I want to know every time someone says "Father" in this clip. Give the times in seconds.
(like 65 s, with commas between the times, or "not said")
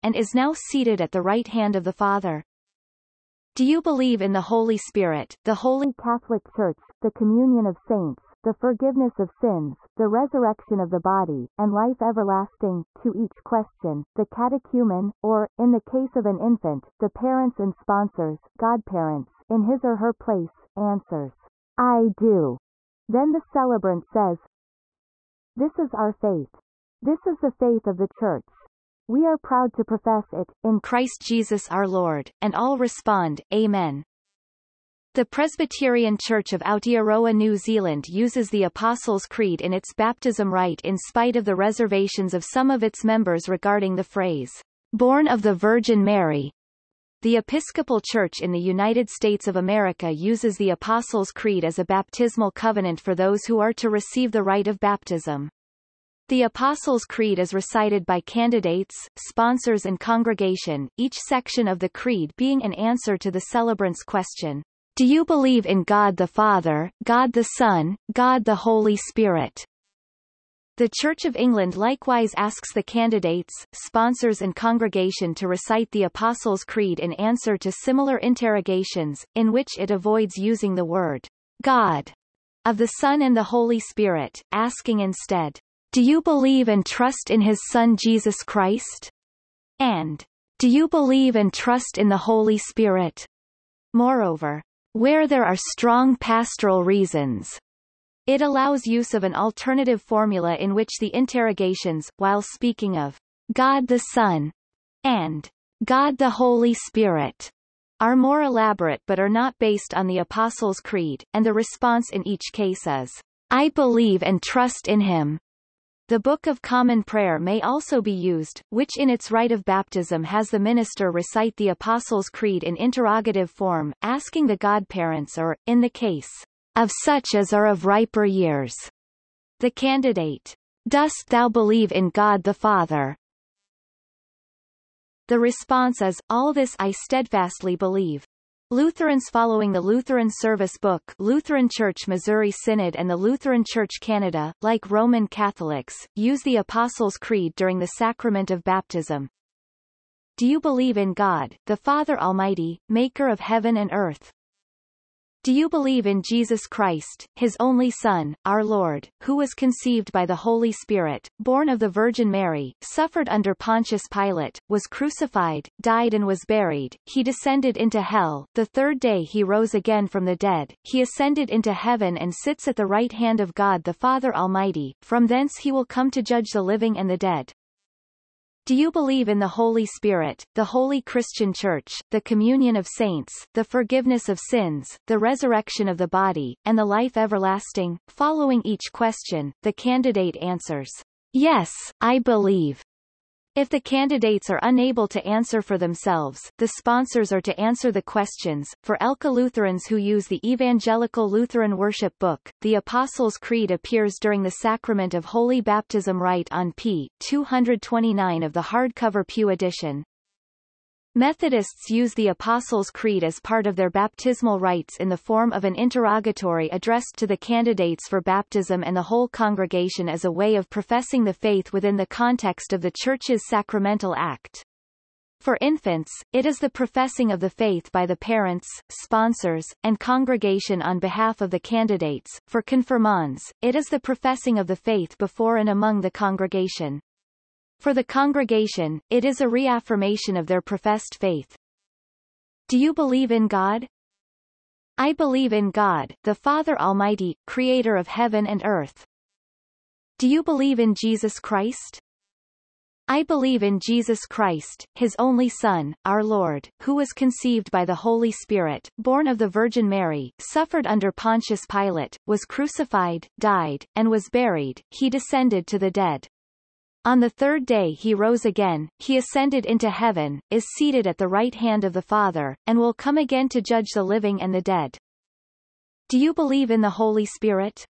1 s, 66 s, 132 s, 151 s, 173 s, 246 s, 272 s.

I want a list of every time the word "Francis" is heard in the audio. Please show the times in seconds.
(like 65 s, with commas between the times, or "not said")
not said.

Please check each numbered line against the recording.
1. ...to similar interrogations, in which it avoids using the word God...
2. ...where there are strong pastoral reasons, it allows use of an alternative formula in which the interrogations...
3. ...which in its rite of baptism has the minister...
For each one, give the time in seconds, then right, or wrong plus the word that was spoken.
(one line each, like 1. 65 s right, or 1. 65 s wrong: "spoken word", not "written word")
1. 77 s right
2. 94 s right
3. 118 s right.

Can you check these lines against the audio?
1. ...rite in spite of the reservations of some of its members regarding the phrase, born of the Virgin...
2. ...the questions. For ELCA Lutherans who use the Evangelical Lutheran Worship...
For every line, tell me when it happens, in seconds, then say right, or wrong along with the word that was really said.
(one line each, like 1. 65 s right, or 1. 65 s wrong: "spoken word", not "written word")
1. 40 s right
2. 197 s right.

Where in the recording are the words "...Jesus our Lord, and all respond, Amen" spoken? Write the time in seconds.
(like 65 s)
31 s.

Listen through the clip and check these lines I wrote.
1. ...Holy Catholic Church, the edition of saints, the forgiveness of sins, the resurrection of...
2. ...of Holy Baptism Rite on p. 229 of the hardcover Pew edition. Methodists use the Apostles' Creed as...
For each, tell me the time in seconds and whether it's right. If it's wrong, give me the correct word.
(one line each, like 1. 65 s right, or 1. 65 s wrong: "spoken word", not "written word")
1. 5 s wrong: "communion", not "edition"
2. 205 s right.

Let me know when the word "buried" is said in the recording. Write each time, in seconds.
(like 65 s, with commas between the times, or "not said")
166 s, 264 s.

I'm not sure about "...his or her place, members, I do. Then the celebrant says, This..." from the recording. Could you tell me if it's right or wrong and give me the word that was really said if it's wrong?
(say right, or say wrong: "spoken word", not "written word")
wrong: "answers", not "members".